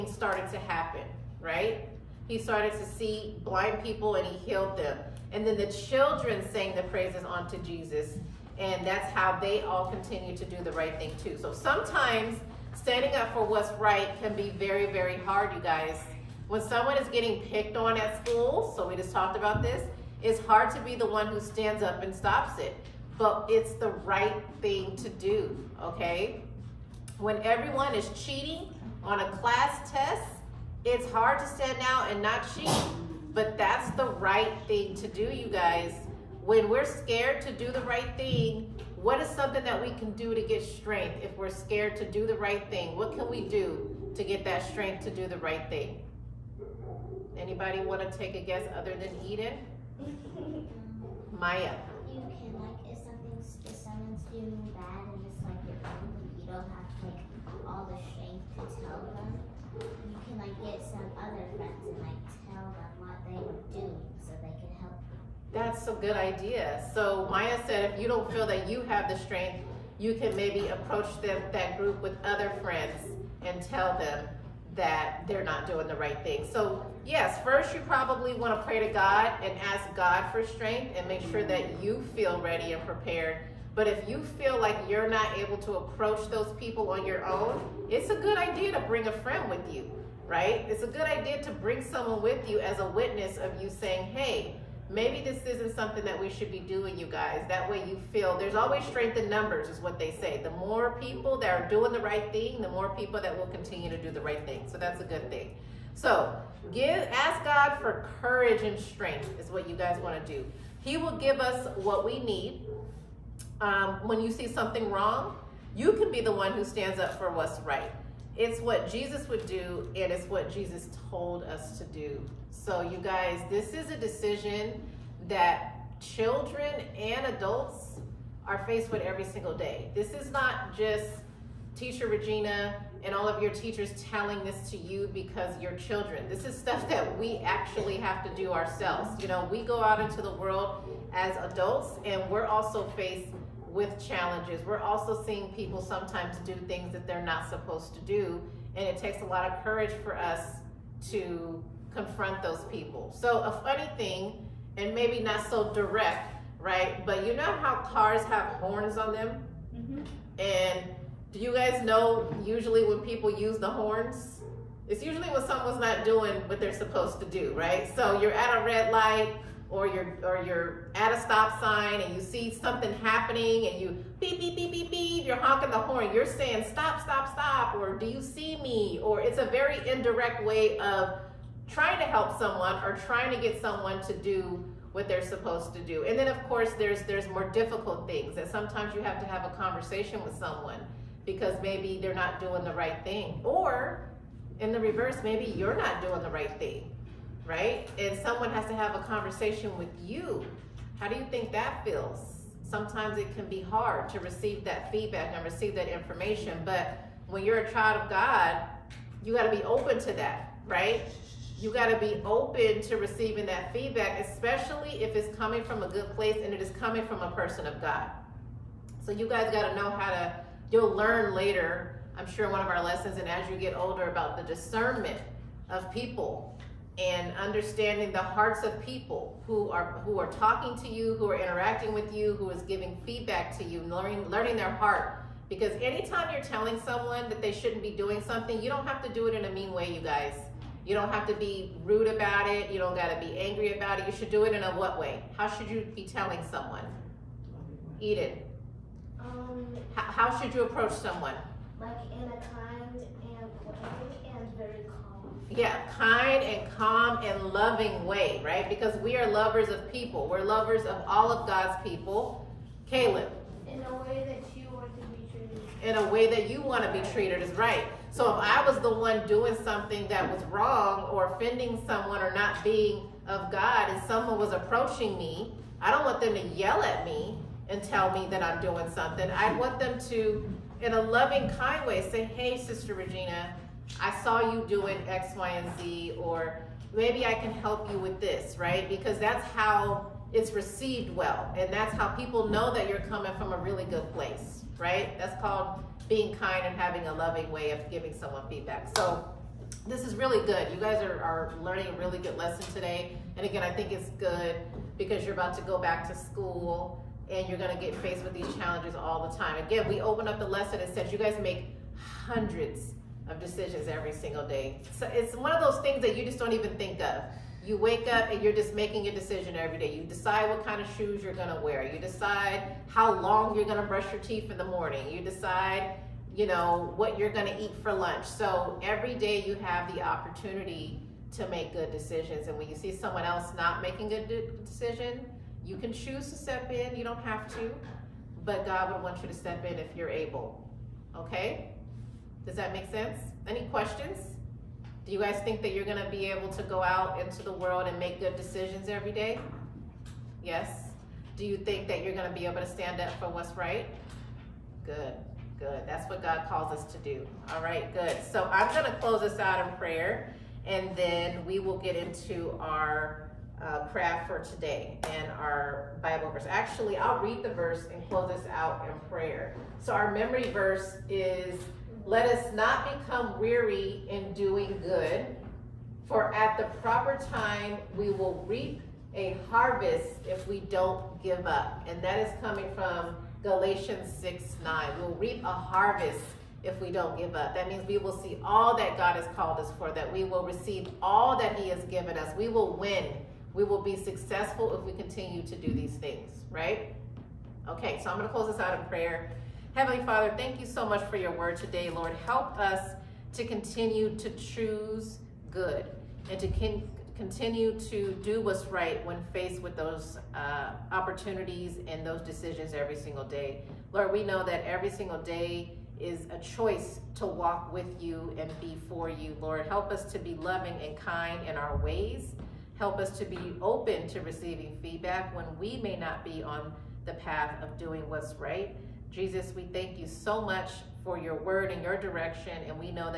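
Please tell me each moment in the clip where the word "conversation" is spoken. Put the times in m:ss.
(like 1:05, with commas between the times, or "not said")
3:09, 3:19.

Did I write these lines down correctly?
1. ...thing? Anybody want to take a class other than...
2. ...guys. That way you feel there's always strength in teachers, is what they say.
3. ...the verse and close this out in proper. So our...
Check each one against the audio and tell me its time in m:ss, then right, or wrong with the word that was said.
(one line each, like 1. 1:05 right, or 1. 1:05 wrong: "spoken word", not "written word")
1. 0:45 wrong: "guess", not "class"
2. 1:37 wrong: "numbers", not "teachers"
3. 6:07 wrong: "prayer", not "proper".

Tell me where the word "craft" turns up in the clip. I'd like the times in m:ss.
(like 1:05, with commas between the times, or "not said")
6:03.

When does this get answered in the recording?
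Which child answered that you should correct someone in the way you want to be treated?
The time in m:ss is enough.
4:22.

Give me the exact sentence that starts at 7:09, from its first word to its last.
Jesus, we thank you so much for your word and your direction.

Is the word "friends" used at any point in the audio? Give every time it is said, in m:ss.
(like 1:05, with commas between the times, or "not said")
1:12, 1:29.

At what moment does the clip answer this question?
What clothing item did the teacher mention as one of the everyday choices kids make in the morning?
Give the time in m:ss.
5:20.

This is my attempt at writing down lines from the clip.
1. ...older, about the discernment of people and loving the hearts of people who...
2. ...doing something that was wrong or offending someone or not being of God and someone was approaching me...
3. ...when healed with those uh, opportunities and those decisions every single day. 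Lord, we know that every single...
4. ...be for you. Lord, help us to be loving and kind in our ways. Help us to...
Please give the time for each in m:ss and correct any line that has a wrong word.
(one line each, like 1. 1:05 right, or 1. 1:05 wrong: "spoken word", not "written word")
1. 3:43 wrong: "understanding", not "loving"
2. 4:29 right
3. 6:49 wrong: "faced", not "healed"
4. 6:58 right.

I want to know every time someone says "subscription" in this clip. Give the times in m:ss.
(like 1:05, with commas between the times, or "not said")
not said.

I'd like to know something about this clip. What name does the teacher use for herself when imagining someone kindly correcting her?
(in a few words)
Sister Regina.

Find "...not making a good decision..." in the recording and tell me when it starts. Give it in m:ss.
5:33.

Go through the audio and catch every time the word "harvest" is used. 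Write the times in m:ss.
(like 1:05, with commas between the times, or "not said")
6:19, 6:25.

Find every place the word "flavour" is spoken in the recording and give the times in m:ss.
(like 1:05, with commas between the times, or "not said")
not said.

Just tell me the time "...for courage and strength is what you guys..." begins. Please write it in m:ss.
1:47.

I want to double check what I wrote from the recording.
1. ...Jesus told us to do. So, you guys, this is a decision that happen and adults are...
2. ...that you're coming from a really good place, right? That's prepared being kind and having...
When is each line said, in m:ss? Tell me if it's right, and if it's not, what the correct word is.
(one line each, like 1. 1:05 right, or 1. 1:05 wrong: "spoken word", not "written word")
1. 2:00 wrong: "children", not "happen"
2. 4:52 wrong: "called", not "prepared".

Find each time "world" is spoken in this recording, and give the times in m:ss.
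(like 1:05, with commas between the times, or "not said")
2:20, 5:47.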